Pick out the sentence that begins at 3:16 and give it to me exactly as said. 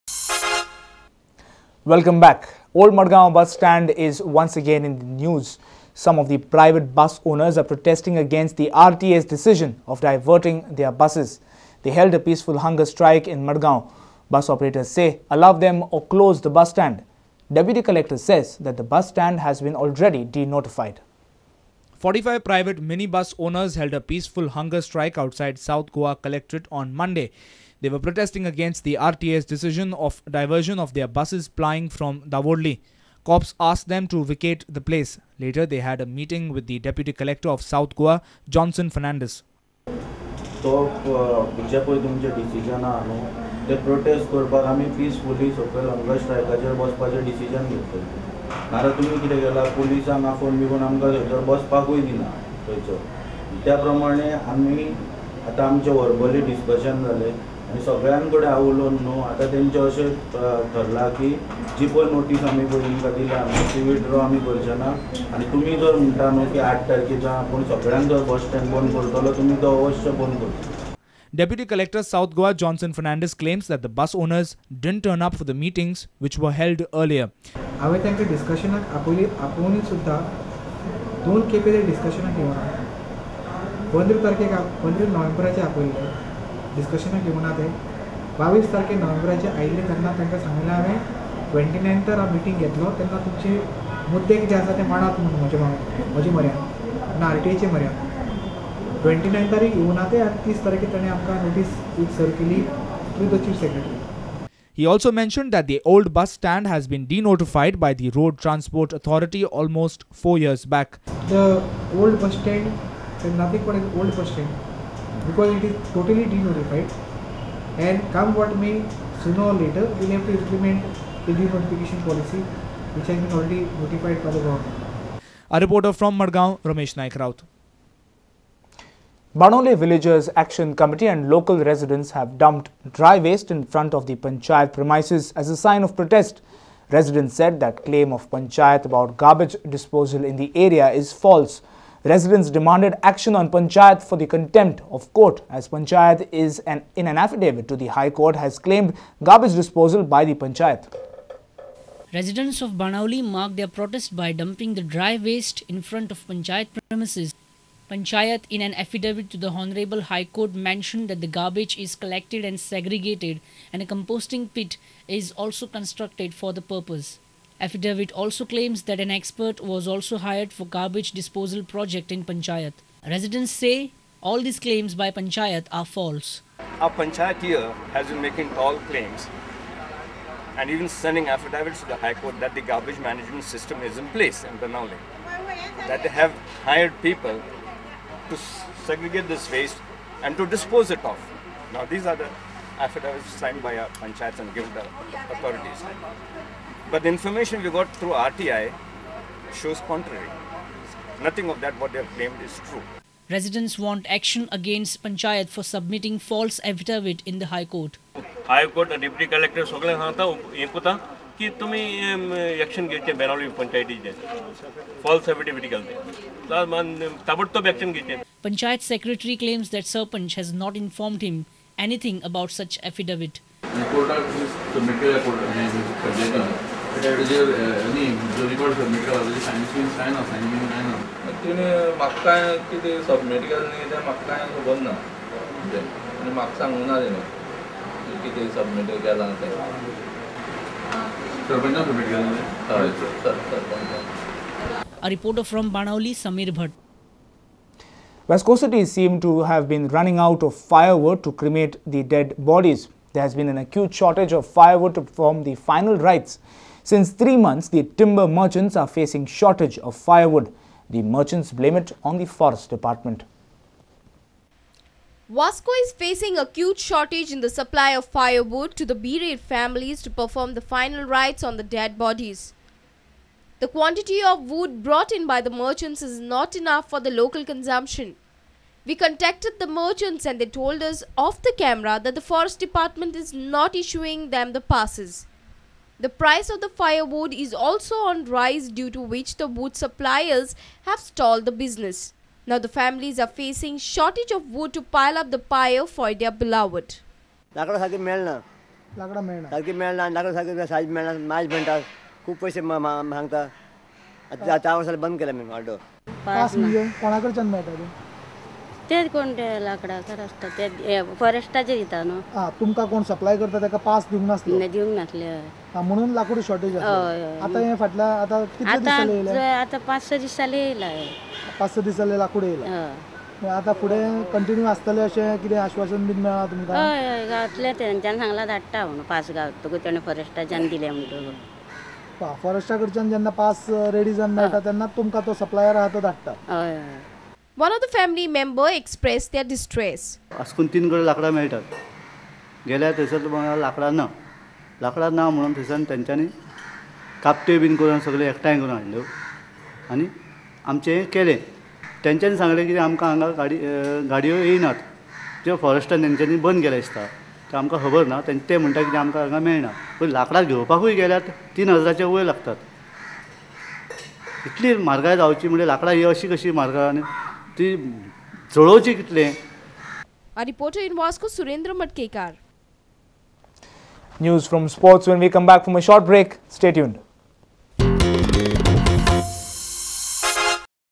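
But the information we got through RTI shows contrary.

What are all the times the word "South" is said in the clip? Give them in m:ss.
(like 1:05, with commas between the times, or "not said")
0:25, 0:37, 1:12.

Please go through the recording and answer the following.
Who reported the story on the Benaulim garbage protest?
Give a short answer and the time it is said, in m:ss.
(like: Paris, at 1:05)
Samir Bhatt, at 4:06.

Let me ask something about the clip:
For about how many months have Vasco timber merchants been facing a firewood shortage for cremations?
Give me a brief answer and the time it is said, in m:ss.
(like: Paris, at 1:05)
3, at 4:17.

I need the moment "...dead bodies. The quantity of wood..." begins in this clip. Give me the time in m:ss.
4:31.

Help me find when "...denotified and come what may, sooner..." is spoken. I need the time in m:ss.
1:56.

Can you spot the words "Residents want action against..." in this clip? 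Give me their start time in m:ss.
3:23.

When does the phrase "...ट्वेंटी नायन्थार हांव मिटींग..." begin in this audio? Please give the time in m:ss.
1:31.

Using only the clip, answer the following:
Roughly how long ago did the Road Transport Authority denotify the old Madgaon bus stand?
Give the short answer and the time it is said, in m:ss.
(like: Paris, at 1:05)
4 years, at 1:50.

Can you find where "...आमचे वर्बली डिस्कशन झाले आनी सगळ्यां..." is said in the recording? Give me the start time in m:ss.
0:55.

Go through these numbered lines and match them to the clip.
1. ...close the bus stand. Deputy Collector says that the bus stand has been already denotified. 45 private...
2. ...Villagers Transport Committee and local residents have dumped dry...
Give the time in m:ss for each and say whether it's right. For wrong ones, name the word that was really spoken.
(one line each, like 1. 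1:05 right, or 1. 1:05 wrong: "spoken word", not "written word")
1. 0:16 right
2. 2:09 wrong: "Action", not "Transport".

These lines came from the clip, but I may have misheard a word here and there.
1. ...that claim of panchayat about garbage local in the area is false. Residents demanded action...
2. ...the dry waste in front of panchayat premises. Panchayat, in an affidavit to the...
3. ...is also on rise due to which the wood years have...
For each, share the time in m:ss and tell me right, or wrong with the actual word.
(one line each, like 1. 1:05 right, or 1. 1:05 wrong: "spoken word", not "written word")
1. 2:17 wrong: "disposal", not "local"
2. 2:34 right
3. 4:47 wrong: "suppliers", not "years".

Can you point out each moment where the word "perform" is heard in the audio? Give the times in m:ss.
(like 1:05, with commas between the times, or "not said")
4:15, 4:30.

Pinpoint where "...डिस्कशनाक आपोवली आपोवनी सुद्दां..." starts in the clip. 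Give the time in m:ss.
1:18.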